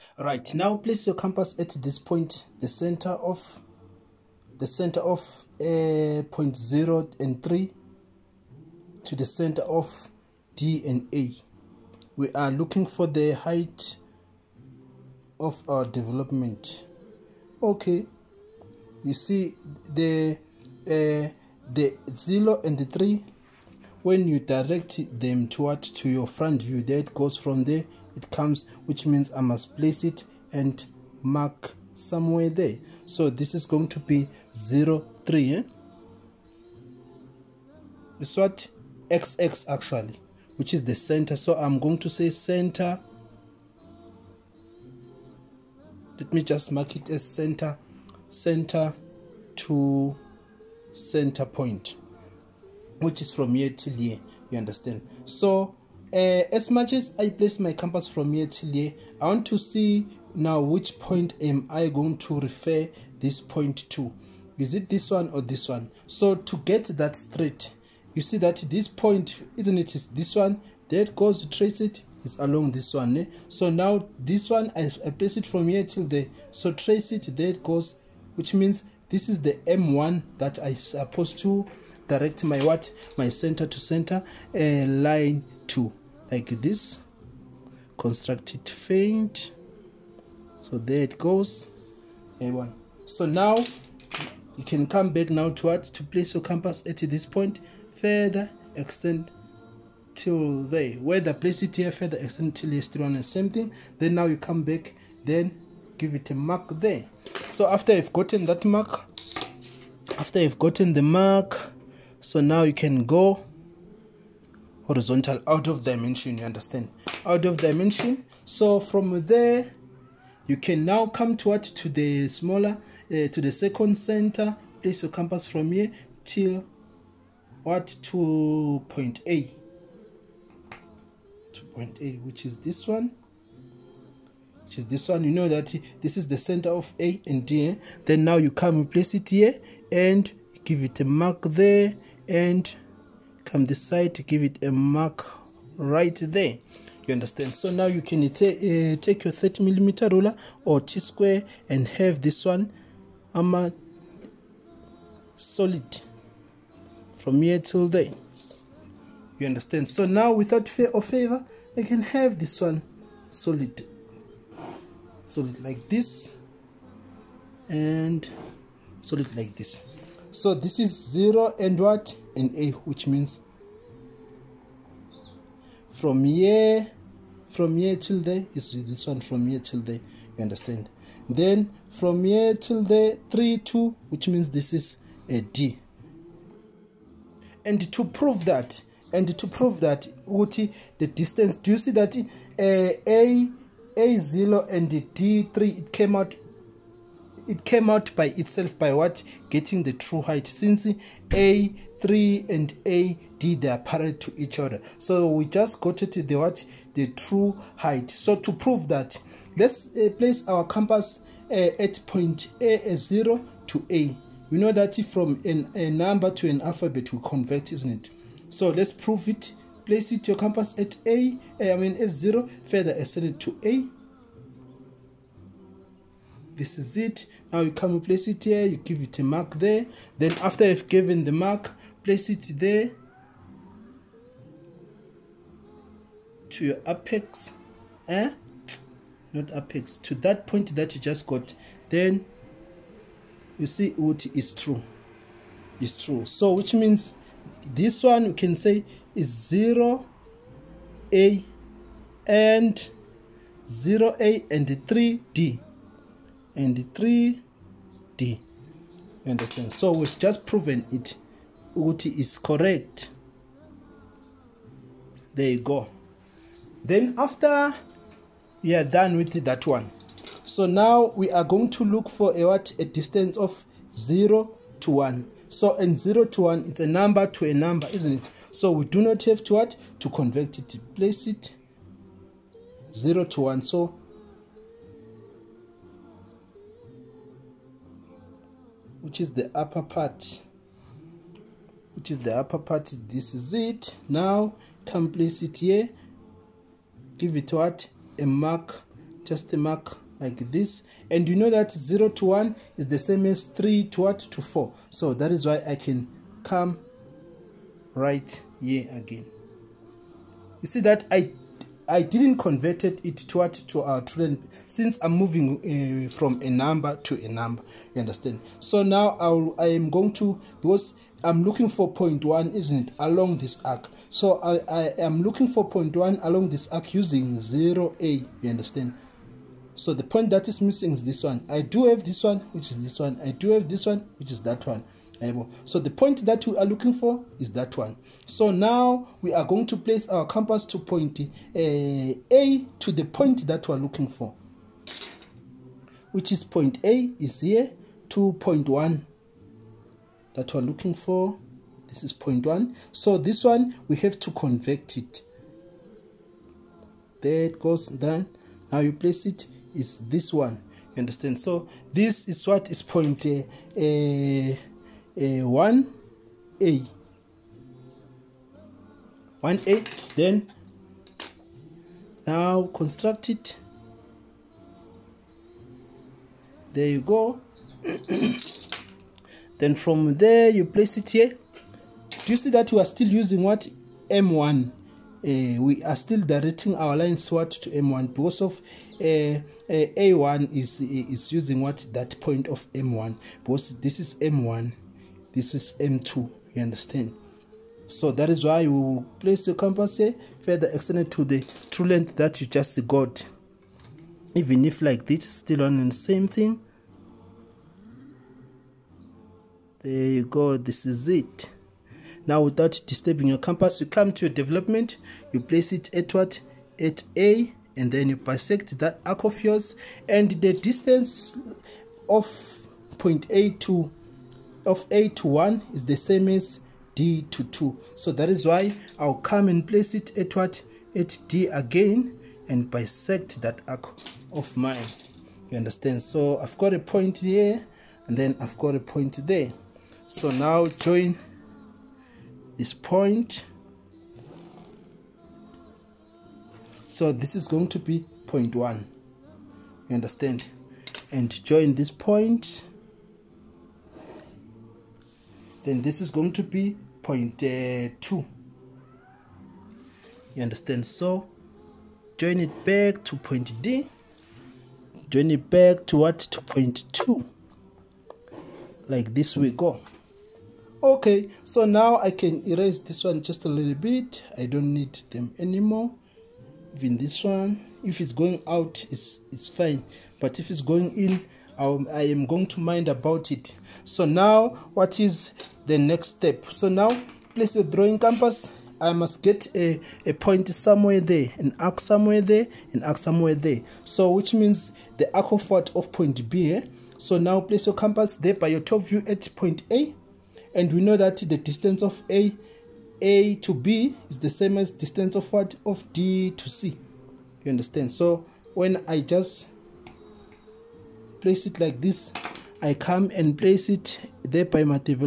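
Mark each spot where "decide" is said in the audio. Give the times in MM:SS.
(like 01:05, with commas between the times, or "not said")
02:23.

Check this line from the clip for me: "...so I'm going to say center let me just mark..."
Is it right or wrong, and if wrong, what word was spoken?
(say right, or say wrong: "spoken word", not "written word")
right.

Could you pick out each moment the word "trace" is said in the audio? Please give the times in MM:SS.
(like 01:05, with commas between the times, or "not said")
01:11, 01:16.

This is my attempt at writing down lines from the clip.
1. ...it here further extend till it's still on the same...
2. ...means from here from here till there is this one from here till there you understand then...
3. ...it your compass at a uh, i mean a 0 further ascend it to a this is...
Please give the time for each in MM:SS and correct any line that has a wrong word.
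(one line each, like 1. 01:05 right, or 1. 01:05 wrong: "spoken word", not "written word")
1. 01:41 right
2. 02:53 right
3. 03:40 right.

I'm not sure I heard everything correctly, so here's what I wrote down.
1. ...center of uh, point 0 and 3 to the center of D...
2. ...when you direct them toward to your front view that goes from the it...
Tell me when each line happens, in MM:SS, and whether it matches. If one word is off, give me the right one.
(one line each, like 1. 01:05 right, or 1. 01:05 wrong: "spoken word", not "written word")
1. 00:04 right
2. 00:24 right.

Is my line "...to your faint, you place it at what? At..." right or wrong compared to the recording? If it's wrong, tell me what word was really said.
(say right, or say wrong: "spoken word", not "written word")
wrong: "development", not "faint".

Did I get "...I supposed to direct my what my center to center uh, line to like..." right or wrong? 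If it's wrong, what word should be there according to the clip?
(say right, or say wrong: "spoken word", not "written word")
right.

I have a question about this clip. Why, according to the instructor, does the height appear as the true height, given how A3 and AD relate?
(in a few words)
They are parallel.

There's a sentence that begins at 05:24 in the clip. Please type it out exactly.
So I, I am looking for point one along this arc using zero A.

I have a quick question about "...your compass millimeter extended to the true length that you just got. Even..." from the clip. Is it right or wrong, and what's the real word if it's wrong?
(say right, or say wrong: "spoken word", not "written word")
wrong: "further", not "millimeter".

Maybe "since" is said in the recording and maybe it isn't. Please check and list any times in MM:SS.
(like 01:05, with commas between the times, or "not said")
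03:20, 05:14.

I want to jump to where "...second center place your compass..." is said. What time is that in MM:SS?
02:03.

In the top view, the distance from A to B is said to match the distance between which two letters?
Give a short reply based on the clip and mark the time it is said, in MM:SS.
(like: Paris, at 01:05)
D to C, at 08:25.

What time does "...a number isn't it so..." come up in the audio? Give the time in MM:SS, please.
04:37.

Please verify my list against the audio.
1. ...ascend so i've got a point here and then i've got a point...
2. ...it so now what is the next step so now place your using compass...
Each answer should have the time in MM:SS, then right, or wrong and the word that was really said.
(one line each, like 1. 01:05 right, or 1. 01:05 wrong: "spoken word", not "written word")
1. 07:15 wrong: "understand", not "ascend"
2. 08:03 wrong: "drawing", not "using".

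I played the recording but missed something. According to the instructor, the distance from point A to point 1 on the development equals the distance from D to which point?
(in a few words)
2.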